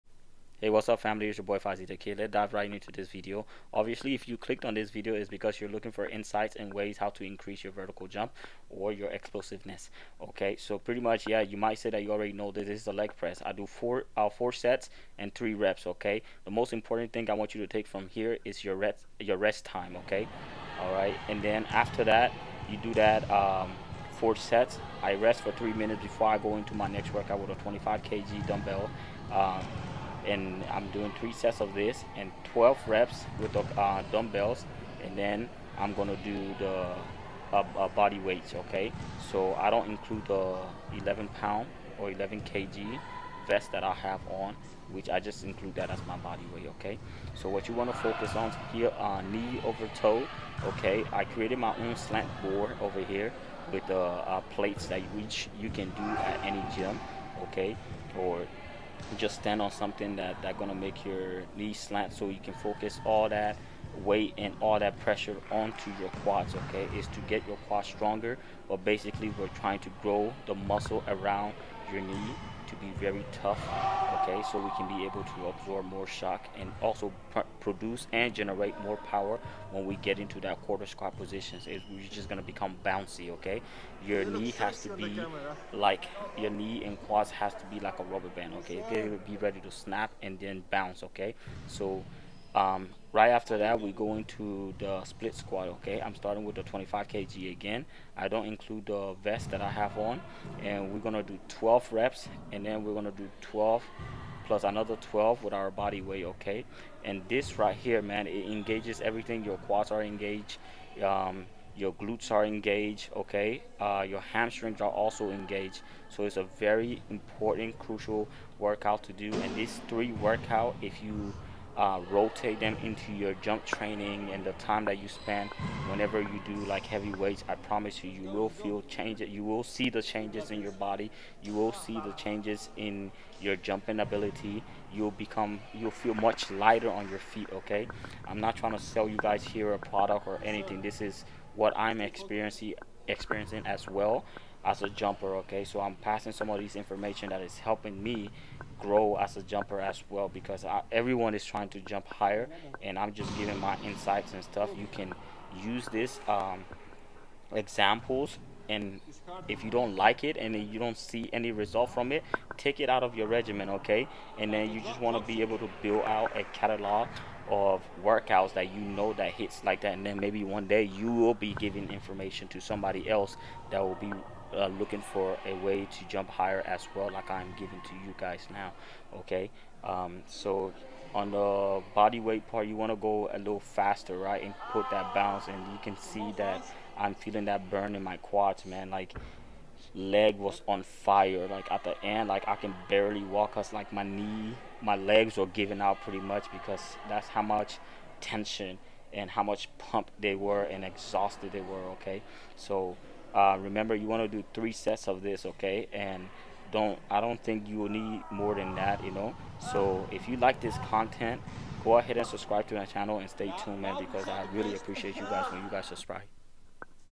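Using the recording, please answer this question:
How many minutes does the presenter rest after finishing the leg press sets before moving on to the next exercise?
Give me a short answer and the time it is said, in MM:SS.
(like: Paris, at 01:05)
3, at 00:25.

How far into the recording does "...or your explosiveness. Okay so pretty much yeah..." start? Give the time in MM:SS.
00:08.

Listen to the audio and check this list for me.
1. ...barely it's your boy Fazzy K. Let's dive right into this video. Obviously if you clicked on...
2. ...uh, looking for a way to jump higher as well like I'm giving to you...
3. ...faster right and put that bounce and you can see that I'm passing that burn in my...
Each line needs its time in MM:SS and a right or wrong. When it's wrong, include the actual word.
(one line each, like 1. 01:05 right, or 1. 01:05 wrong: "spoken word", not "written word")
1. 00:00 wrong: "family", not "barely"
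2. 02:54 right
3. 03:03 wrong: "feeling", not "passing".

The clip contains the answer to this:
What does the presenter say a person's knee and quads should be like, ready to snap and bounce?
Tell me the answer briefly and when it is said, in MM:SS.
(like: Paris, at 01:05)
a rubber band, at 01:27.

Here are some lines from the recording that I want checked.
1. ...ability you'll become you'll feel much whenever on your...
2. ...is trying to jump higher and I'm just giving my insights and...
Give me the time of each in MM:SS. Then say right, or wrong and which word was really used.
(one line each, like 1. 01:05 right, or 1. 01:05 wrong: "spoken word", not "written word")
1. 02:14 wrong: "lighter", not "whenever"
2. 02:31 right.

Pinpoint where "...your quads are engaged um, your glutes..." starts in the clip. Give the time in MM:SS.
01:49.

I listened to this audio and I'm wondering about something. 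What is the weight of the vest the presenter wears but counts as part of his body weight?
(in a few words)
11 kg.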